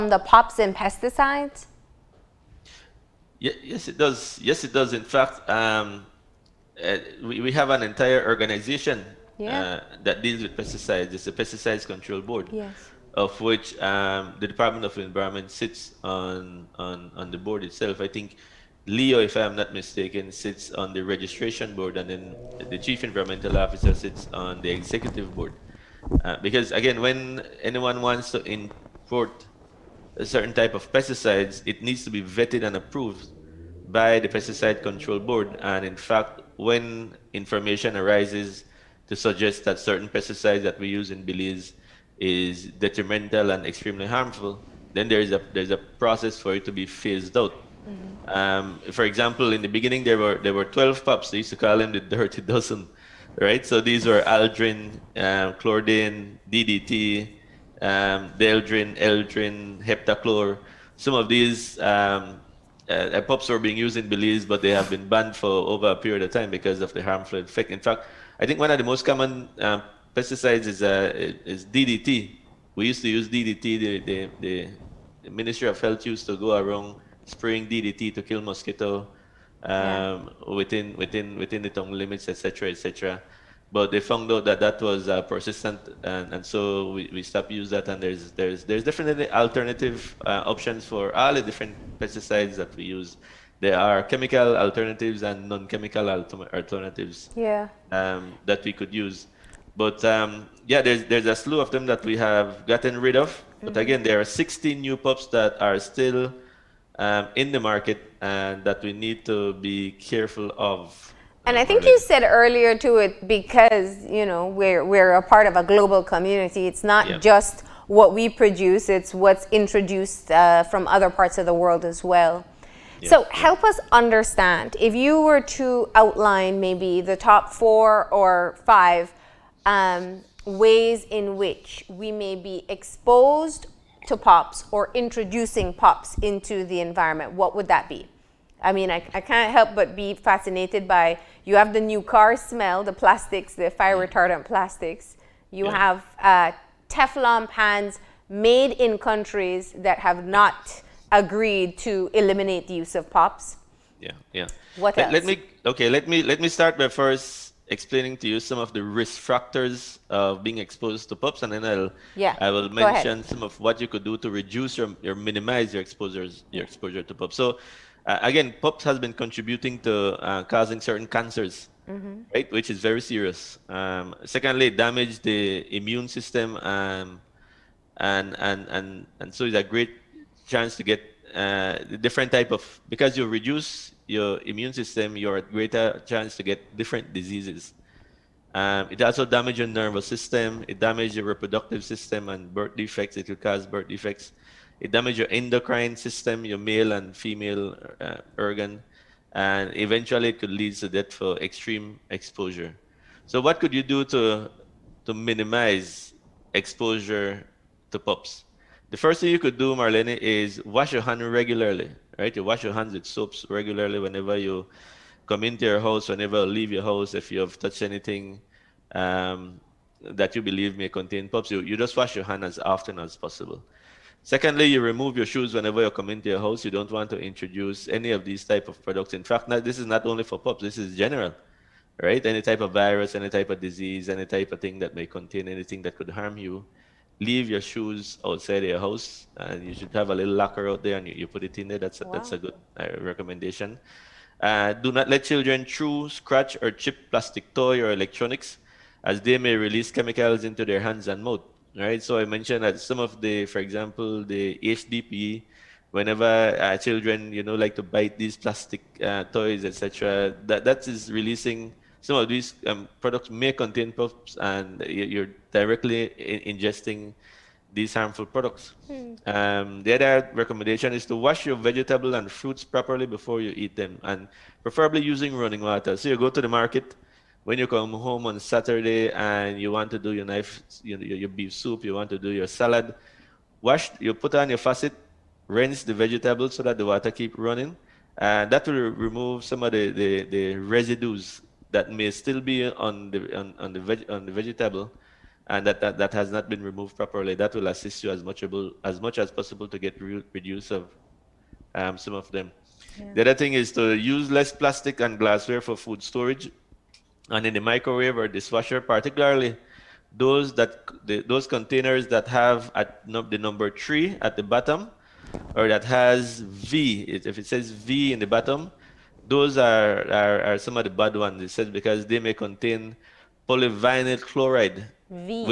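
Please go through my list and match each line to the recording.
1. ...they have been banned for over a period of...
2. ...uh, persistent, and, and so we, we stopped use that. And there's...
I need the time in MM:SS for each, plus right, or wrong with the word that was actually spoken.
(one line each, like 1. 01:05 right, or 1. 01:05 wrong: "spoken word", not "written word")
1. 01:04 right
2. 01:25 right.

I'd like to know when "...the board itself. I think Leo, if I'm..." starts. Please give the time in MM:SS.
00:17.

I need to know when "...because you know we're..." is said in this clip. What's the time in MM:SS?
01:53.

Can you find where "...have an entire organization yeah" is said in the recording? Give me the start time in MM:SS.
00:07.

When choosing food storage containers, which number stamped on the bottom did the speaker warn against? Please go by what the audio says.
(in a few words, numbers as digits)
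3.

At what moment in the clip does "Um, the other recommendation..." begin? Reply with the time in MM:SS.
04:29.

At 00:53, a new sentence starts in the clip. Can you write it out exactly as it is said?
So these were Aldrin, um, Chlordane, DDT, um, Dieldrin, Endrin, Heptachlor.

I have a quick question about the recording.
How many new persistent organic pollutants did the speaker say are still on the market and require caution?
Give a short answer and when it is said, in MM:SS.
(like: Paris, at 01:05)
16, at 01:44.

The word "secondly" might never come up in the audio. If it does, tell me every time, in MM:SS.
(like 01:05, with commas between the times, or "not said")
02:54, 03:44.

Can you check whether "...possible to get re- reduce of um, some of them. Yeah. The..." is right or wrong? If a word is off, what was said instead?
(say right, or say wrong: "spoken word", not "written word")
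right.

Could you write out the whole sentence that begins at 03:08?
Um, it also damages your nervous system.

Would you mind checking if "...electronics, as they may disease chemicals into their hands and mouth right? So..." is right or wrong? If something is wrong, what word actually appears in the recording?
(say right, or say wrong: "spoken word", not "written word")
wrong: "release", not "disease".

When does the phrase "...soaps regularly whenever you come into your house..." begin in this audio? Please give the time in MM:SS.
03:33.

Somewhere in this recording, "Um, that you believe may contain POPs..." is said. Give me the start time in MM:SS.
03:38.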